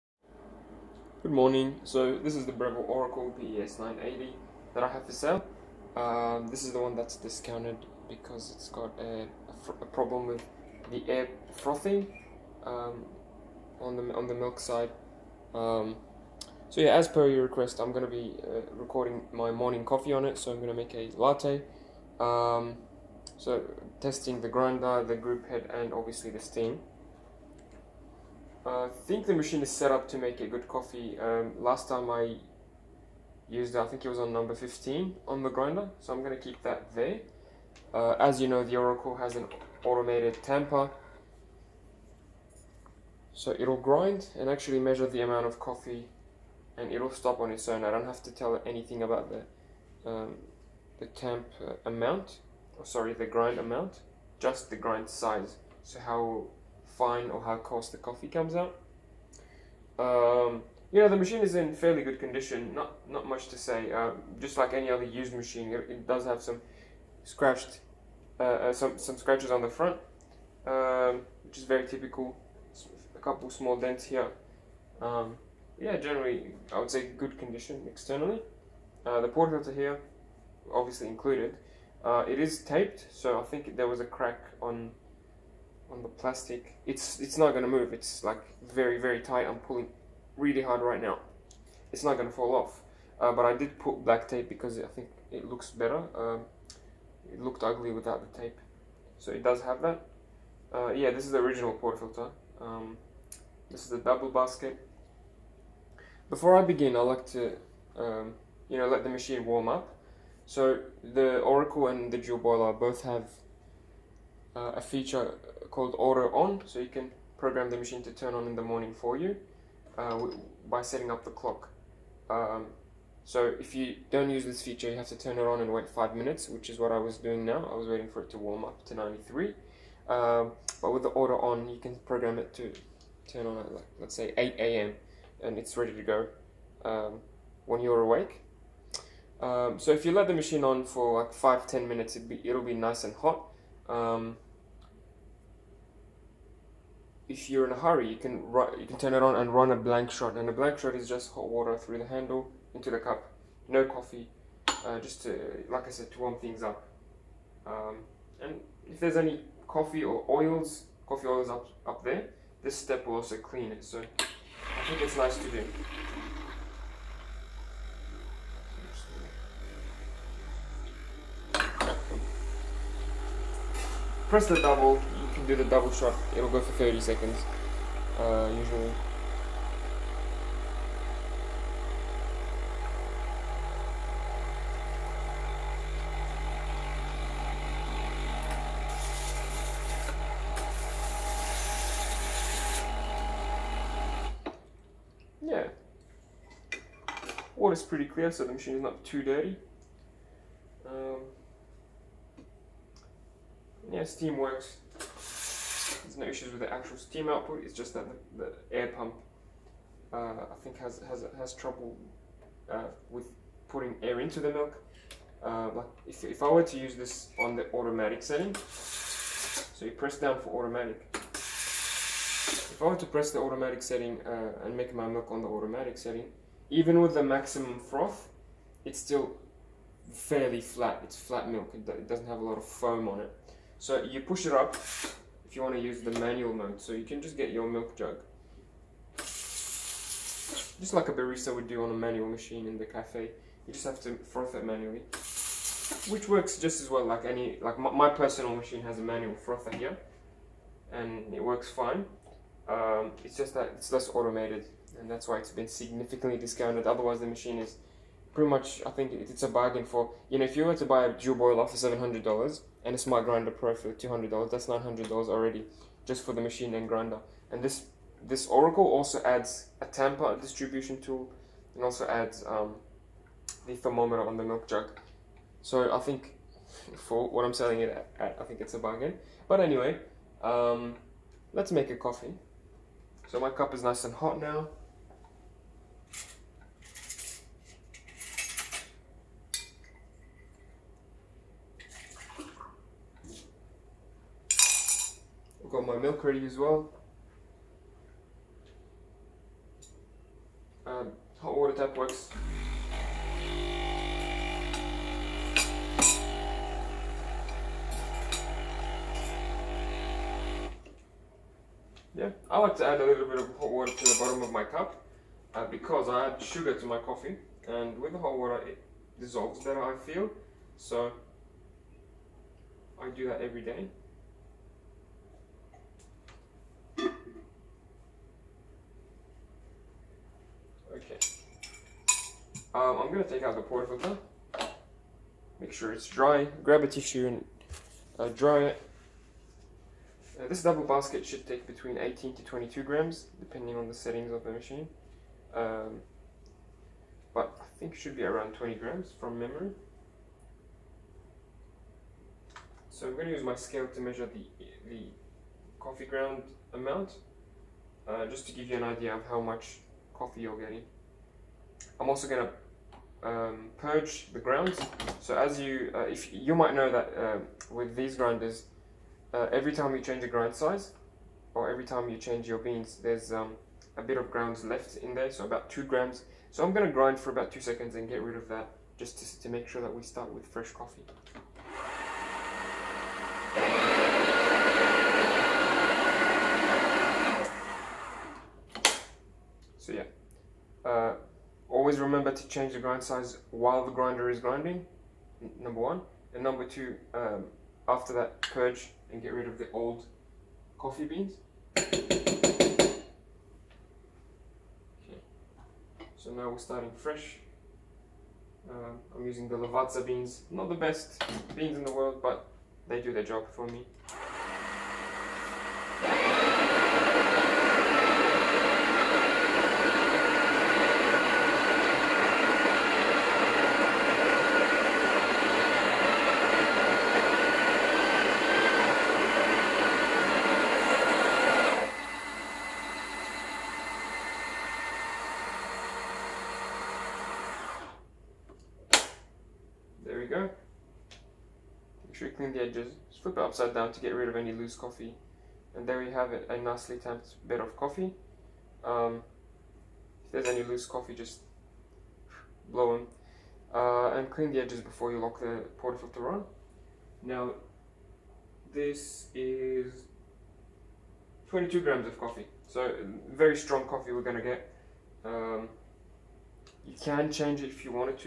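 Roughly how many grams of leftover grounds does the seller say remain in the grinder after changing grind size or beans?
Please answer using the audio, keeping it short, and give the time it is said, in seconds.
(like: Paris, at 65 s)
2 grams, at 375 s.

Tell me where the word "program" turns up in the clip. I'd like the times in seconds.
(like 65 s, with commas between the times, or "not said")
117 s, 132 s.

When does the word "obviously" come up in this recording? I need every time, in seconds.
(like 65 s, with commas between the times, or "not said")
25 s, 80 s.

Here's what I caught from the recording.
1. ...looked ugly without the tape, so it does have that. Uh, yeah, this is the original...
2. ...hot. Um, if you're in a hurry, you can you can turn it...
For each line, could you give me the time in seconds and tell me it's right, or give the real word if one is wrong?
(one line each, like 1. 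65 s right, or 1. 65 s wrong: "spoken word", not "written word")
1. 97 s right
2. 143 s right.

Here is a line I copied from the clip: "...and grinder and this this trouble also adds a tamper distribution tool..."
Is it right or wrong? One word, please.
wrong.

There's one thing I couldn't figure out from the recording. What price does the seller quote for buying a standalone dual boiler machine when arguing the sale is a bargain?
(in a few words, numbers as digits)
$700.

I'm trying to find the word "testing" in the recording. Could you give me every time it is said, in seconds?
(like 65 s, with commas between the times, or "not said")
23 s.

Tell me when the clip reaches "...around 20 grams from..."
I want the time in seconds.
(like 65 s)
348 s.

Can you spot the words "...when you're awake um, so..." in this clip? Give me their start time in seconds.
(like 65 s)
137 s.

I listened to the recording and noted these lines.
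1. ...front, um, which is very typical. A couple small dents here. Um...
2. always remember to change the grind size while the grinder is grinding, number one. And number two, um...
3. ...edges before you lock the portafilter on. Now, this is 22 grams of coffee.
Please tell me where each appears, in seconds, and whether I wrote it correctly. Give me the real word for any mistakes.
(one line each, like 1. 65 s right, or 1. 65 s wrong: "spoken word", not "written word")
1. 69 s right
2. 391 s right
3. 454 s right.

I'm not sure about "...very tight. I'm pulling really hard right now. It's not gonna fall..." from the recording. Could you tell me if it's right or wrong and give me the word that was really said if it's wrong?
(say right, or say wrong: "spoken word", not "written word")
right.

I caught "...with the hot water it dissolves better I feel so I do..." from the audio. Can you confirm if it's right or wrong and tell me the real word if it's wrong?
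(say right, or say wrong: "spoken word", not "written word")
right.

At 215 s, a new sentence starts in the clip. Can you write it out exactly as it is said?
Uh, like if, if I were to use this on the automatic setting, so you press down for automatic.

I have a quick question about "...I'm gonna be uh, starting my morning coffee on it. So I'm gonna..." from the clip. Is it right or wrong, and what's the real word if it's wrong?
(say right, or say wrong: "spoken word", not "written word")
wrong: "recording", not "starting".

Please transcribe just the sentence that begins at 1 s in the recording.
So this is the Breville Oracle BES 980 that I have for sale.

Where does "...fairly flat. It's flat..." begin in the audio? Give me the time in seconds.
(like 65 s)
230 s.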